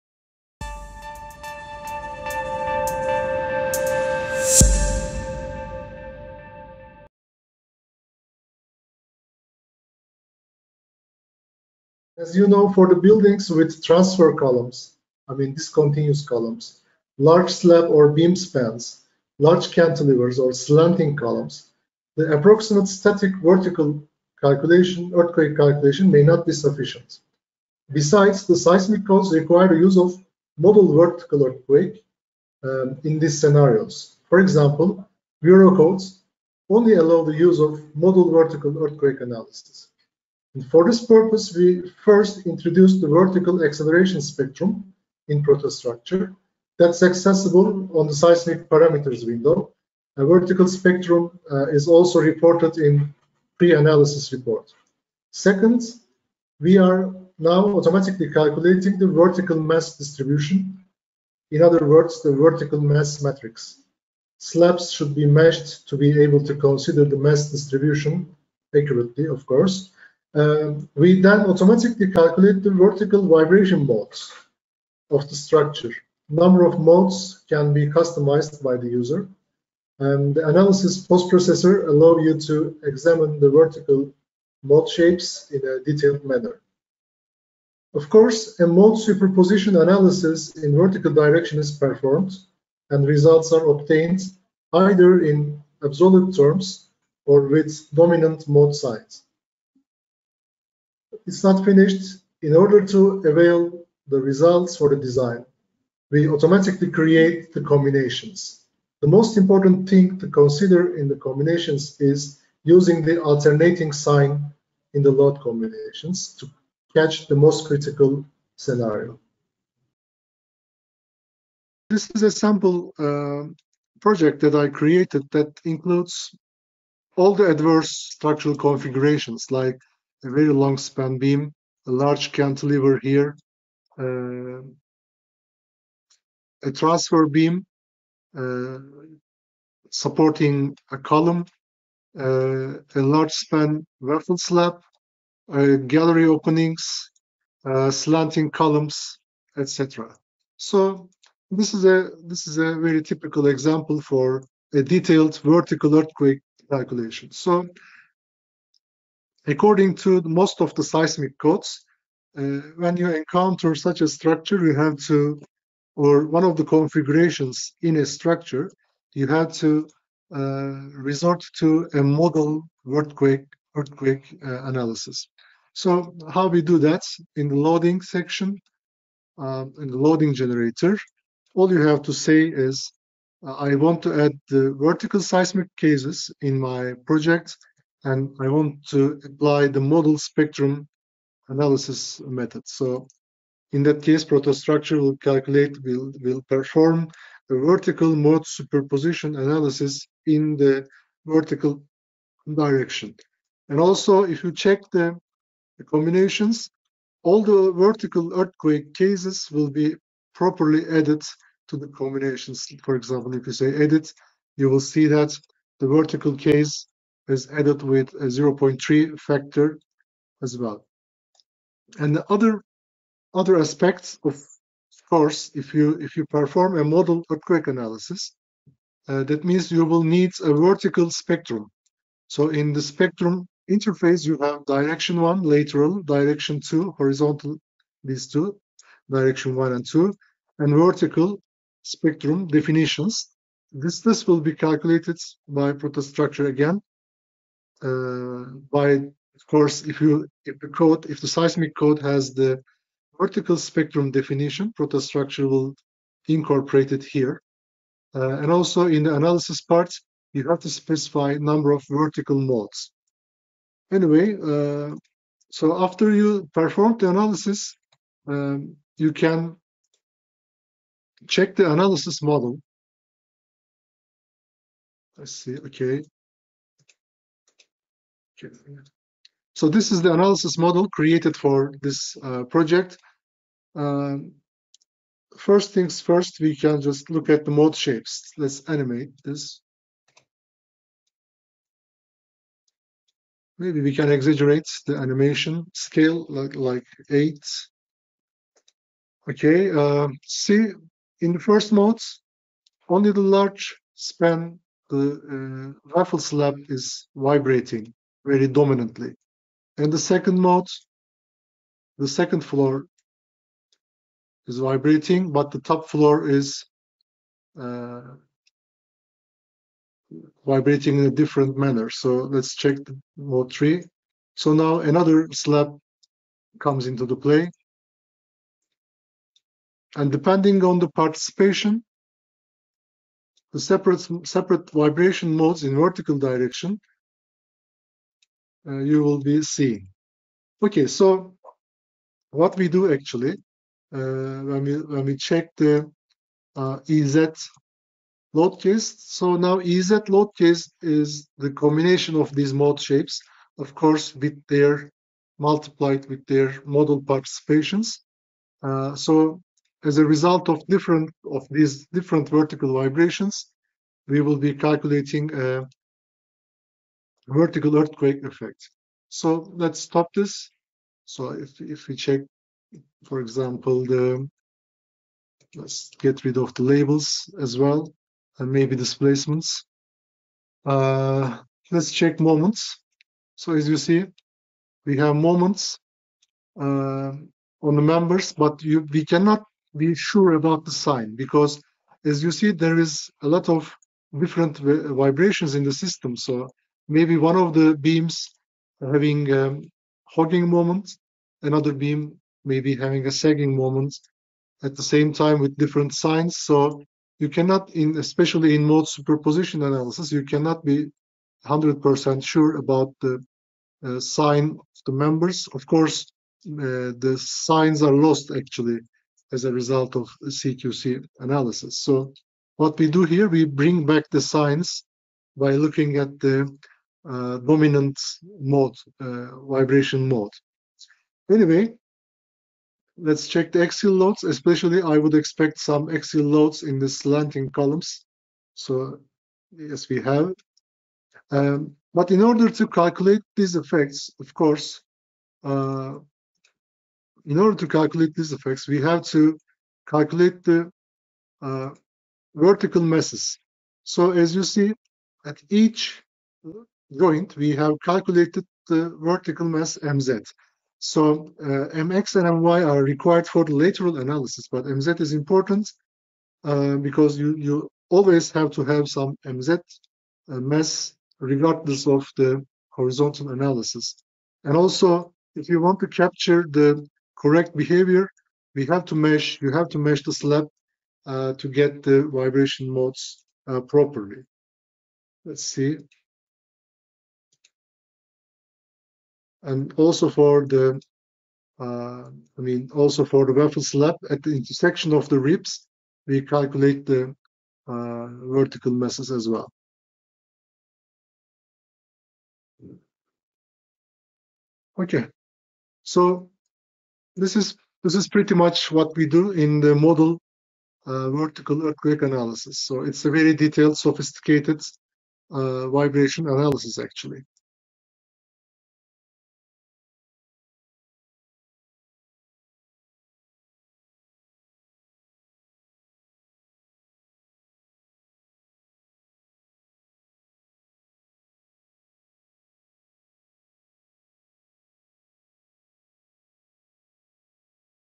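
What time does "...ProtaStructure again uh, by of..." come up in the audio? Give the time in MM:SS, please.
04:05.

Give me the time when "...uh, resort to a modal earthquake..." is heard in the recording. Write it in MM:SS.
02:50.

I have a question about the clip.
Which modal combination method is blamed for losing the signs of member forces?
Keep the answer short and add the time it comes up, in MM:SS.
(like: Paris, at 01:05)
CQC, at 07:00.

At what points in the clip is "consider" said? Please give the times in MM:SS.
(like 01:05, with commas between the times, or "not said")
01:06, 01:50.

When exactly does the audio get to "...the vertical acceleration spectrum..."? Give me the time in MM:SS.
00:42.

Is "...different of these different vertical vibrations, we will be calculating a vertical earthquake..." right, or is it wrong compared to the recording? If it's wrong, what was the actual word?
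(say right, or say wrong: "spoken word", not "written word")
right.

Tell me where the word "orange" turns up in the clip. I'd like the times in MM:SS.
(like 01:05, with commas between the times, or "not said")
not said.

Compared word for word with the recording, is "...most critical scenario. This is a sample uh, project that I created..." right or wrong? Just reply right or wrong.
right.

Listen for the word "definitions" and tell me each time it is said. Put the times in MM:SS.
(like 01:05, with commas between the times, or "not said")
04:02, 04:14.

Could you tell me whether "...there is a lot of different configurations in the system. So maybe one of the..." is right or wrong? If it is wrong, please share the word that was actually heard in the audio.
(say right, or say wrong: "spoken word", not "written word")
wrong: "vibrations", not "configurations".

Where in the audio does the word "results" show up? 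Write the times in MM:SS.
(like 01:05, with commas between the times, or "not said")
01:33, 01:44, 06:00, 06:59.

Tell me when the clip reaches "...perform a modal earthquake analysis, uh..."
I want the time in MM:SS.
03:46.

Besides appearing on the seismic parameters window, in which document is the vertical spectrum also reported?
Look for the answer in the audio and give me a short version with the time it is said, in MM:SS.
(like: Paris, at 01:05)
pre-analysis report, at 00:53.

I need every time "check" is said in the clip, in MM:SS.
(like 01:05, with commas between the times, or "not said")
03:24, 04:31, 05:22, 05:45, 06:11, 06:21, 07:13.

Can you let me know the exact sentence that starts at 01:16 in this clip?
Number of modes can be customized by the user.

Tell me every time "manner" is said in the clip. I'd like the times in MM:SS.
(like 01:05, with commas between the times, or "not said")
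01:26, 05:21.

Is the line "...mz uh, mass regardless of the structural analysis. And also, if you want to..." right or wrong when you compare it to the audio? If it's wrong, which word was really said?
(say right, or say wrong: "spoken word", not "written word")
wrong: "horizontal", not "structural".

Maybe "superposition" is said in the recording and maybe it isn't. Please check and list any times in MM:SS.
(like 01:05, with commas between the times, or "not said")
01:28, 03:18, 06:48.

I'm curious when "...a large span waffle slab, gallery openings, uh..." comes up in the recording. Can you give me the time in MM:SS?
02:22.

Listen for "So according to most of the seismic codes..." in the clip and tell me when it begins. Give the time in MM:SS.
02:37.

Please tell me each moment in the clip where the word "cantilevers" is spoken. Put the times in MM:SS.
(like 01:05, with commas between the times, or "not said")
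00:19, 02:12.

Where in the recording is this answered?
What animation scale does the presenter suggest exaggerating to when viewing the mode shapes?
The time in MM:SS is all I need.
04:57.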